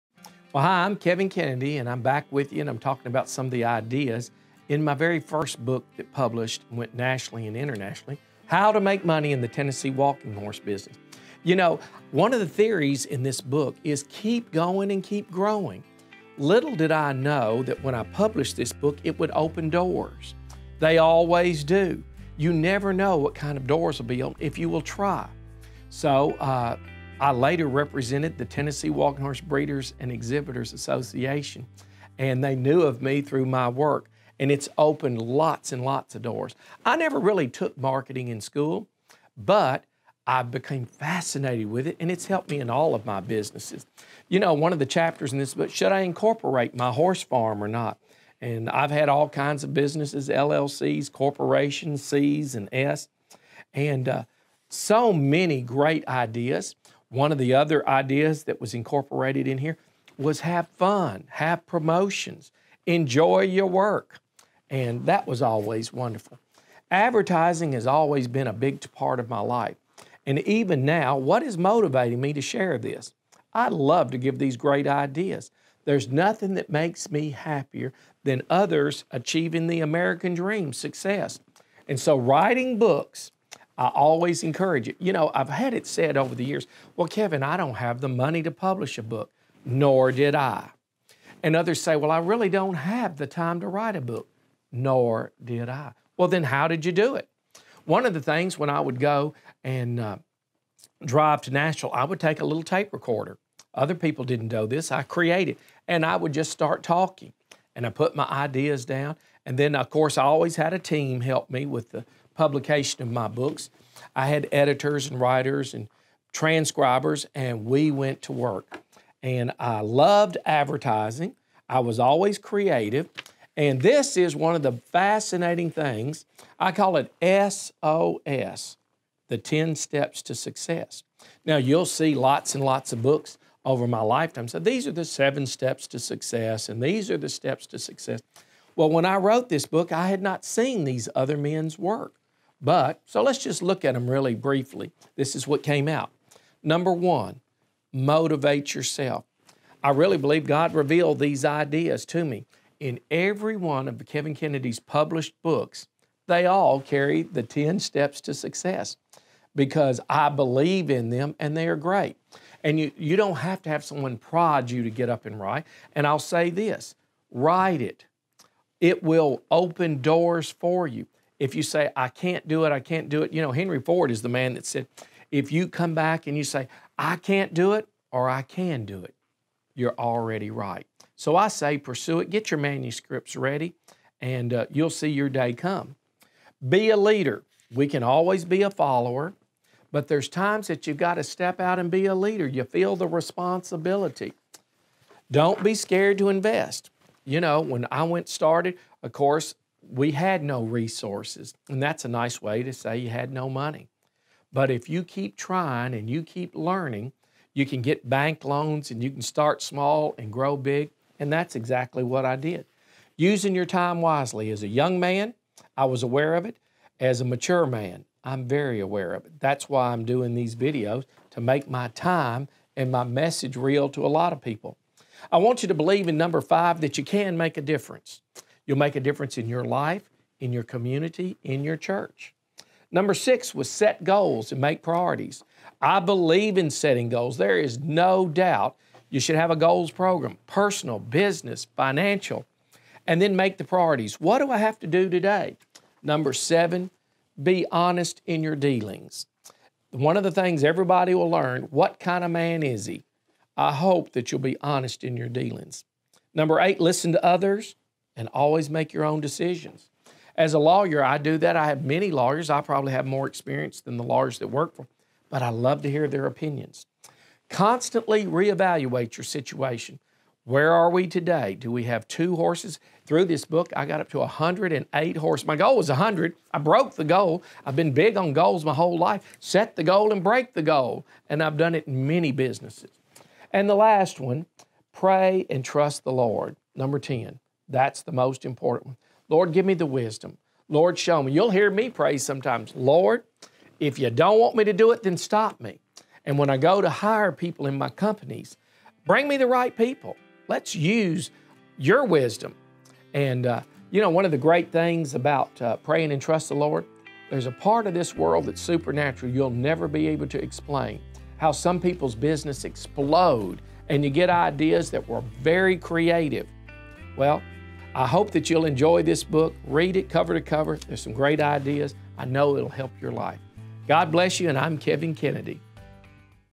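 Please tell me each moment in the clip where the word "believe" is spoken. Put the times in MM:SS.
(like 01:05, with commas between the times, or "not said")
02:30, 02:40, 03:45, 03:55.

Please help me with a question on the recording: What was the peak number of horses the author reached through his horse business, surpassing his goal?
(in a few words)
108.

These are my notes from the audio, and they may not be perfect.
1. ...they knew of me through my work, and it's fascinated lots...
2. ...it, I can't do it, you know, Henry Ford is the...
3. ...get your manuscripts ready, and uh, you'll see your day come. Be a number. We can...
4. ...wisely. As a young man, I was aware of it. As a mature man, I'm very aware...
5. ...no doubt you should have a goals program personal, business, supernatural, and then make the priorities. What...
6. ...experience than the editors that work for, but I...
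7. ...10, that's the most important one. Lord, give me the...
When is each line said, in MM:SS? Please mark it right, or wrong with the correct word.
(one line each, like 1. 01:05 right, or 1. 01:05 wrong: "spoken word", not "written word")
1. 00:32 wrong: "opened", not "fascinated"
2. 02:52 right
3. 03:02 wrong: "leader", not "number"
4. 03:34 right
5. 03:57 wrong: "financial", not "supernatural"
6. 04:23 wrong: "lawyers", not "editors"
7. 04:46 right.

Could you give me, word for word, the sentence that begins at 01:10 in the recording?
And even now, what is motivating me to share this?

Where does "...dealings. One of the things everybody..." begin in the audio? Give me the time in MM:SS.
04:08.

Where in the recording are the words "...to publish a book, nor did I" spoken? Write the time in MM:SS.
01:28.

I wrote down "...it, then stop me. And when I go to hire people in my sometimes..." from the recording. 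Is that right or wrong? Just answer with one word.
wrong.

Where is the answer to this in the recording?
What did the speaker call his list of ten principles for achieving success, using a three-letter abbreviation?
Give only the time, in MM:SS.
02:07.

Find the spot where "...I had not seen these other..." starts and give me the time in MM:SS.
02:19.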